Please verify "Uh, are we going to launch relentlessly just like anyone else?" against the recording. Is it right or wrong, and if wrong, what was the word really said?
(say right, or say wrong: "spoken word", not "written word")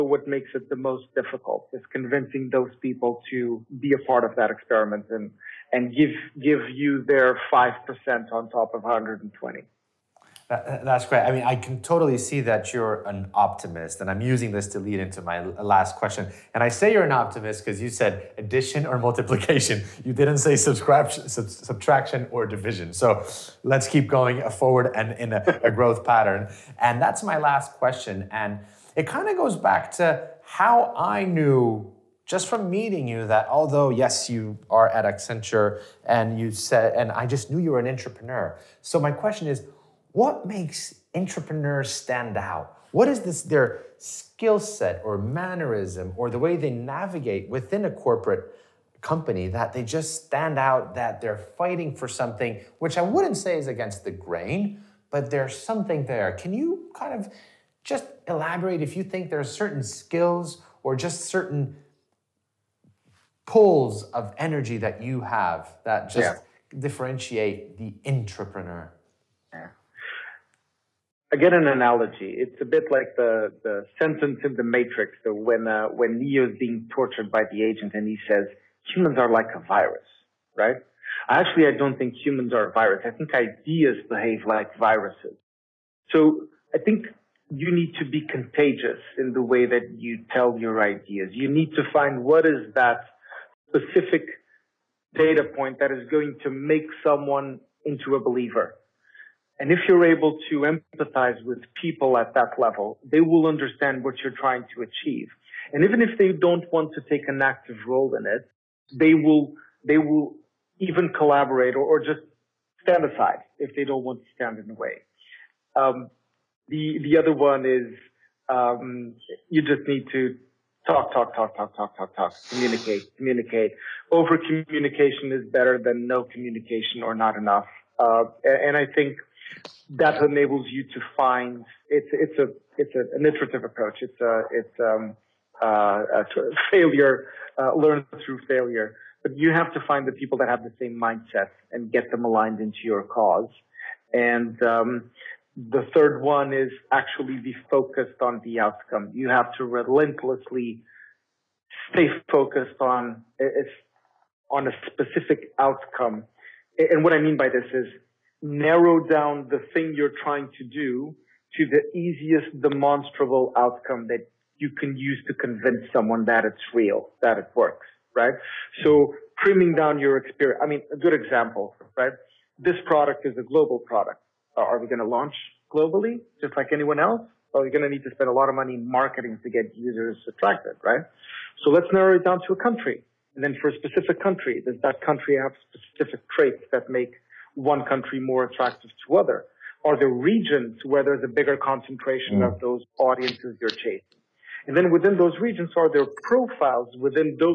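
wrong: "globally", not "relentlessly".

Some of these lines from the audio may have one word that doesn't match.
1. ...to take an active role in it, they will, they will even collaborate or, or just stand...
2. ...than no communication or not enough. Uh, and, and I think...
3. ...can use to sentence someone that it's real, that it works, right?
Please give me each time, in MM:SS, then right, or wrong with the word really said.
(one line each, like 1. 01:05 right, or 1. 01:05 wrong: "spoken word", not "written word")
1. 01:46 right
2. 02:05 right
3. 02:44 wrong: "convince", not "sentence".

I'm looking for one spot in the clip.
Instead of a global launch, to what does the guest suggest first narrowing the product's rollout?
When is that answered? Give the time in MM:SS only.
03:02.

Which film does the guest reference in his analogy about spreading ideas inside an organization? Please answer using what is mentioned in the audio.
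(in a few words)
The Matrix.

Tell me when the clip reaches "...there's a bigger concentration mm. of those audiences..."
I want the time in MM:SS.
03:11.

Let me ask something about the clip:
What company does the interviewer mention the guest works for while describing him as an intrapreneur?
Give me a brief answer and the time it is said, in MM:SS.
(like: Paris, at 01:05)
Accenture, at 00:35.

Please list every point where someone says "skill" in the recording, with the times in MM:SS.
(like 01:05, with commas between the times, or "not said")
00:43, 00:59.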